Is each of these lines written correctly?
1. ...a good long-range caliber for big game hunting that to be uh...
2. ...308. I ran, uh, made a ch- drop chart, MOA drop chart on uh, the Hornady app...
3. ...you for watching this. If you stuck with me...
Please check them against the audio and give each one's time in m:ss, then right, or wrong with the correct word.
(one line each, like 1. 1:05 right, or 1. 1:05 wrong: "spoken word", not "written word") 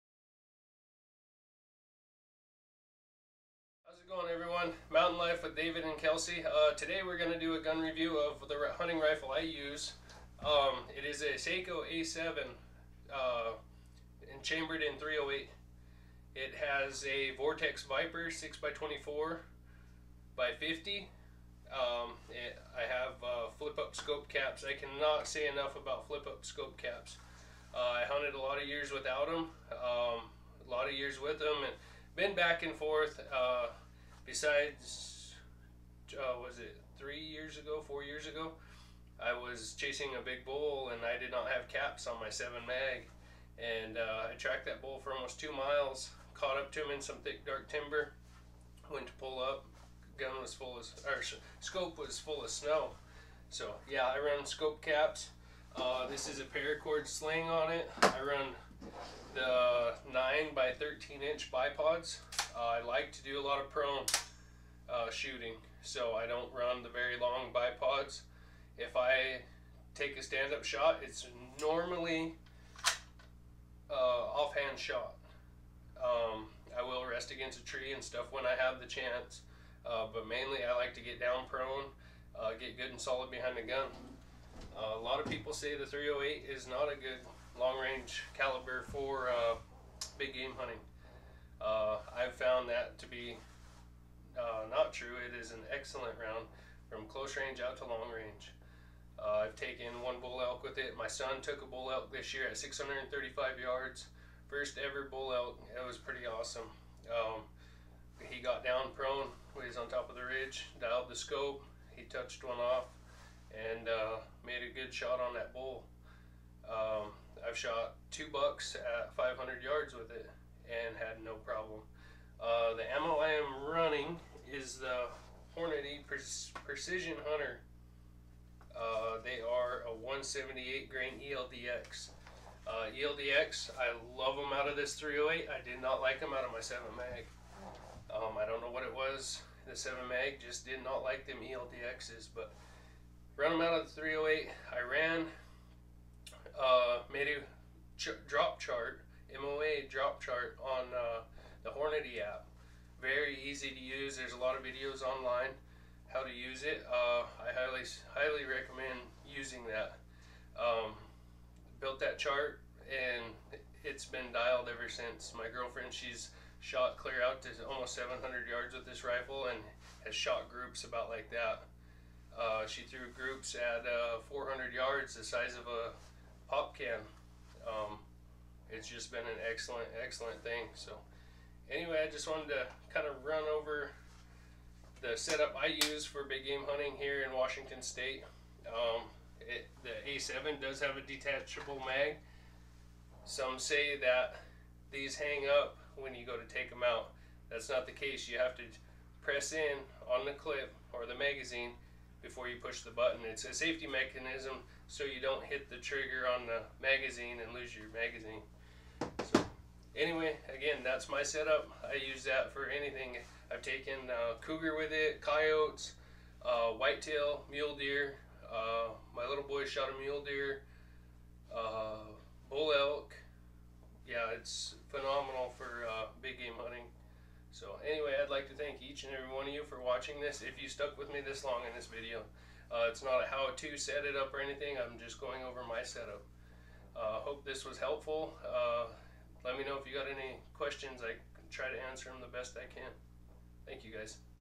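1. 1:26 right
2. 2:24 right
3. 3:49 right.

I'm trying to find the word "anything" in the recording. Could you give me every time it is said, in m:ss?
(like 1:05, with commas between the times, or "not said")
3:32, 3:54.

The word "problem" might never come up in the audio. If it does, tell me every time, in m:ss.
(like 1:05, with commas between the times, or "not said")
2:01.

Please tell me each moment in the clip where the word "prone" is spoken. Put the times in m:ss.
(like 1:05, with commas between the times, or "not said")
1:03, 1:21, 1:48.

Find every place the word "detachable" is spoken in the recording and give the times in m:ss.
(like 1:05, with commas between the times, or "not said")
3:11.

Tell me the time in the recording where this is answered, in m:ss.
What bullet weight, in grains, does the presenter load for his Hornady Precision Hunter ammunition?
2:09.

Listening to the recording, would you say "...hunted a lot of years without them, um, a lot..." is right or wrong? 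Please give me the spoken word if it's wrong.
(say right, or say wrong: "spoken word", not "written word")
right.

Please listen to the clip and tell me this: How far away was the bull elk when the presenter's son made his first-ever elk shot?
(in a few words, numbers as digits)
635 yards.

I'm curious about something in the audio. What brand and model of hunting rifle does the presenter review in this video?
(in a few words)
Sako A7.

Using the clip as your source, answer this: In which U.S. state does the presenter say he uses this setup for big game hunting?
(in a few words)
Washington State.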